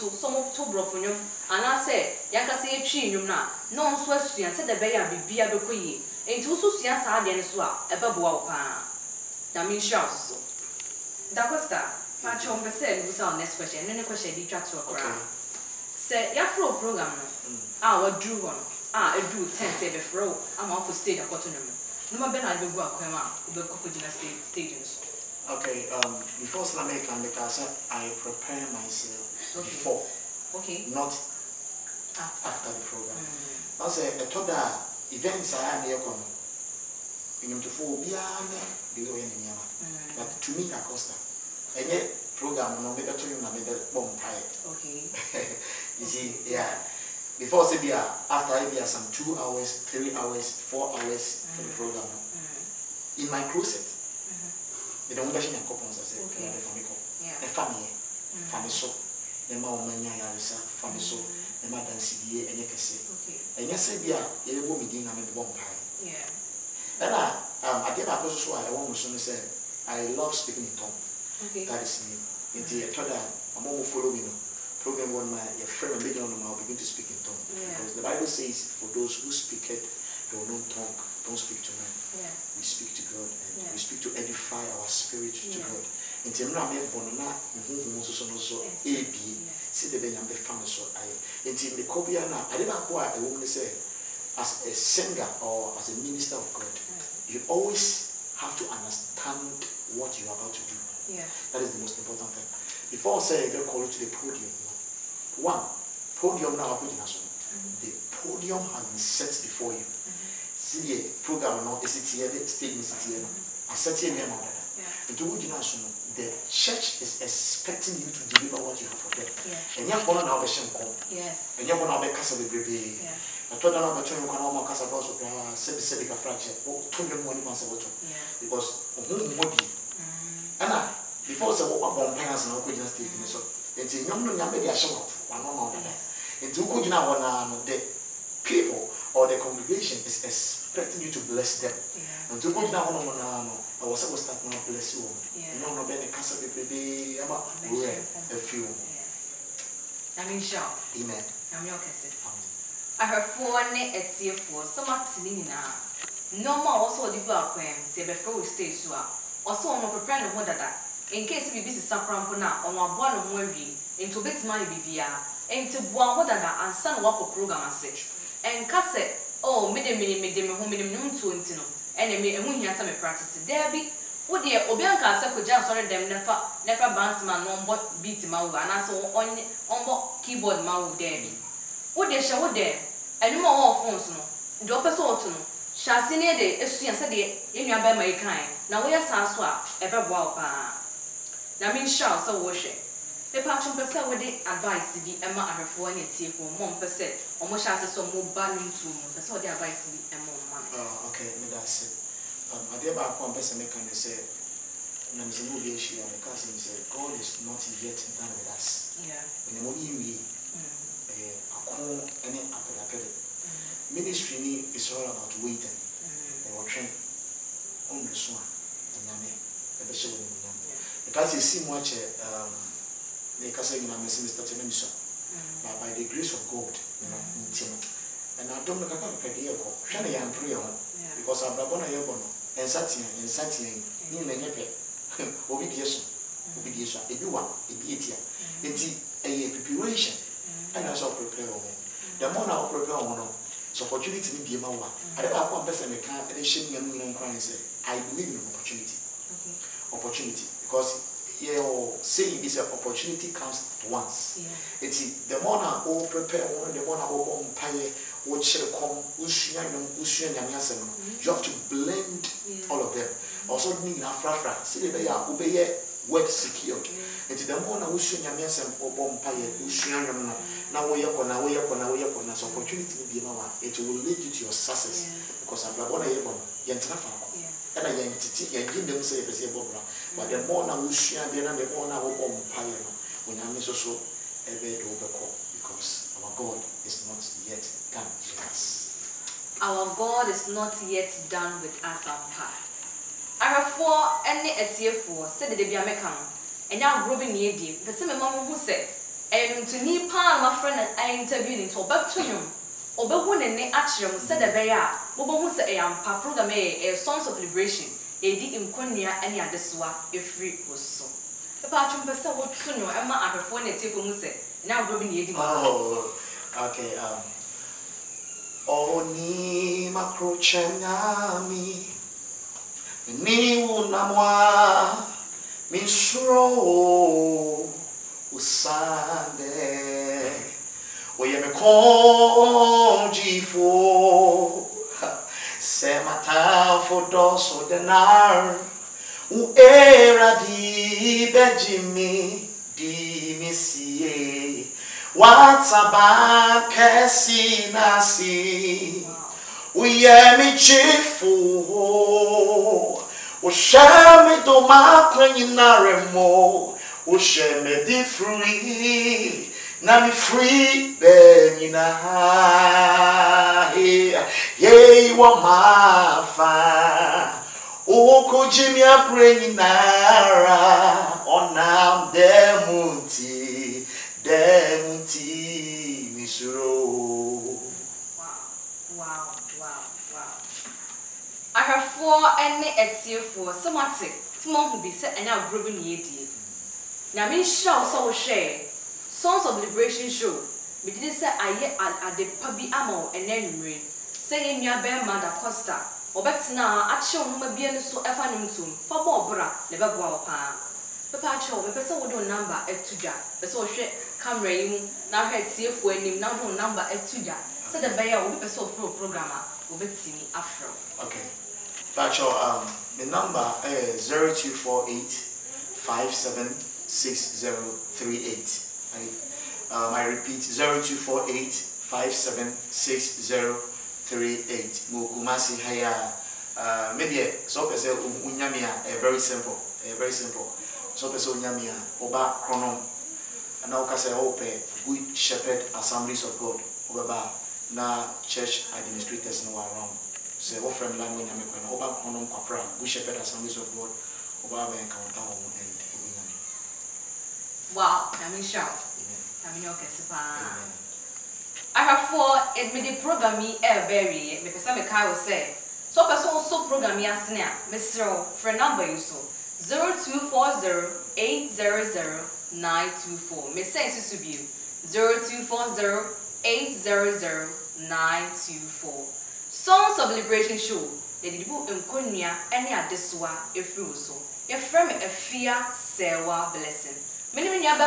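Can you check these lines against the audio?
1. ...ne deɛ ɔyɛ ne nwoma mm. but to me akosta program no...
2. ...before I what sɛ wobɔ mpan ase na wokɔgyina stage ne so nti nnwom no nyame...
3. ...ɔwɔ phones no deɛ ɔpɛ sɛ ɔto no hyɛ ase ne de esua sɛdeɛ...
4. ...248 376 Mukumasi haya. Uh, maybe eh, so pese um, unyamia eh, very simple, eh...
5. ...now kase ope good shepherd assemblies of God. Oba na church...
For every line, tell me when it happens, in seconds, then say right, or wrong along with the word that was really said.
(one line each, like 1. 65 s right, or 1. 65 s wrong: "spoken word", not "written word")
1. 38 s wrong: "nneɛma", not "nwoma"
2. 131 s right
3. 183 s right
4. 420 s wrong: "576", not "376"
5. 433 s right.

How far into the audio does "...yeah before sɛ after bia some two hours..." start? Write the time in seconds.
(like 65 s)
46 s.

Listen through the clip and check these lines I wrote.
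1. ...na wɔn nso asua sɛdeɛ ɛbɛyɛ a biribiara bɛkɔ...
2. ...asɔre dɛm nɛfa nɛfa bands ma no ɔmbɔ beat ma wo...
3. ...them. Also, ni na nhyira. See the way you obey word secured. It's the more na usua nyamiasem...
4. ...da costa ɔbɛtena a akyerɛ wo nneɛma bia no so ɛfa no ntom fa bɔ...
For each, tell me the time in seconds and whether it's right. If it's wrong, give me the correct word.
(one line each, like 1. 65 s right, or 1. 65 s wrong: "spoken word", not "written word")
1. 3 s right
2. 175 s right
3. 262 s wrong: "frafra", not "nhyira"
4. 395 s wrong: "nwoma", not "nneɛma".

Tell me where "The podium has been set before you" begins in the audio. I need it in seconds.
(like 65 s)
107 s.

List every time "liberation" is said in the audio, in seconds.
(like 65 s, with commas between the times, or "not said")
307 s, 389 s, 470 s.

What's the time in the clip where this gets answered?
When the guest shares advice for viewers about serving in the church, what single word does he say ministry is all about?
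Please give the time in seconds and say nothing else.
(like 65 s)
215 s.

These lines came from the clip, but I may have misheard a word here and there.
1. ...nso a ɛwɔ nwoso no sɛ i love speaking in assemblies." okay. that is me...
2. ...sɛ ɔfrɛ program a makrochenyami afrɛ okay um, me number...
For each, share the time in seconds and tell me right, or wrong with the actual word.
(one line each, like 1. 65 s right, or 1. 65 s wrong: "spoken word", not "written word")
1. 68 s wrong: "tongues", not "assemblies"
2. 408 s wrong: "wobɛtumi", not "makrochenyami".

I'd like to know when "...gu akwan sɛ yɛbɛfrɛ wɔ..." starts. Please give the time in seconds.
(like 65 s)
157 s.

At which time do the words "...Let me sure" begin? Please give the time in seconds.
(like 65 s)
448 s.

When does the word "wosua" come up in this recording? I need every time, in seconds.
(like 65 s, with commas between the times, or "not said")
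280 s.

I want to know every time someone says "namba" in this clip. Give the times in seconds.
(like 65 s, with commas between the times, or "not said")
402 s, 406 s.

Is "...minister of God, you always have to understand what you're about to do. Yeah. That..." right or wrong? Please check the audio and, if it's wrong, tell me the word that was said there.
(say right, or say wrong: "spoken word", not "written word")
right.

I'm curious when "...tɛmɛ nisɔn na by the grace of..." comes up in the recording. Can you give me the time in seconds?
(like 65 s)
224 s.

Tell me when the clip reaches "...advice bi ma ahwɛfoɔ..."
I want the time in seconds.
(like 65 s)
194 s.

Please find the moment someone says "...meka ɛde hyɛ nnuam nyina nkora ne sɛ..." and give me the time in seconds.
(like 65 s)
245 s.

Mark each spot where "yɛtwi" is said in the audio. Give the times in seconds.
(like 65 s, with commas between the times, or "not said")
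2 s.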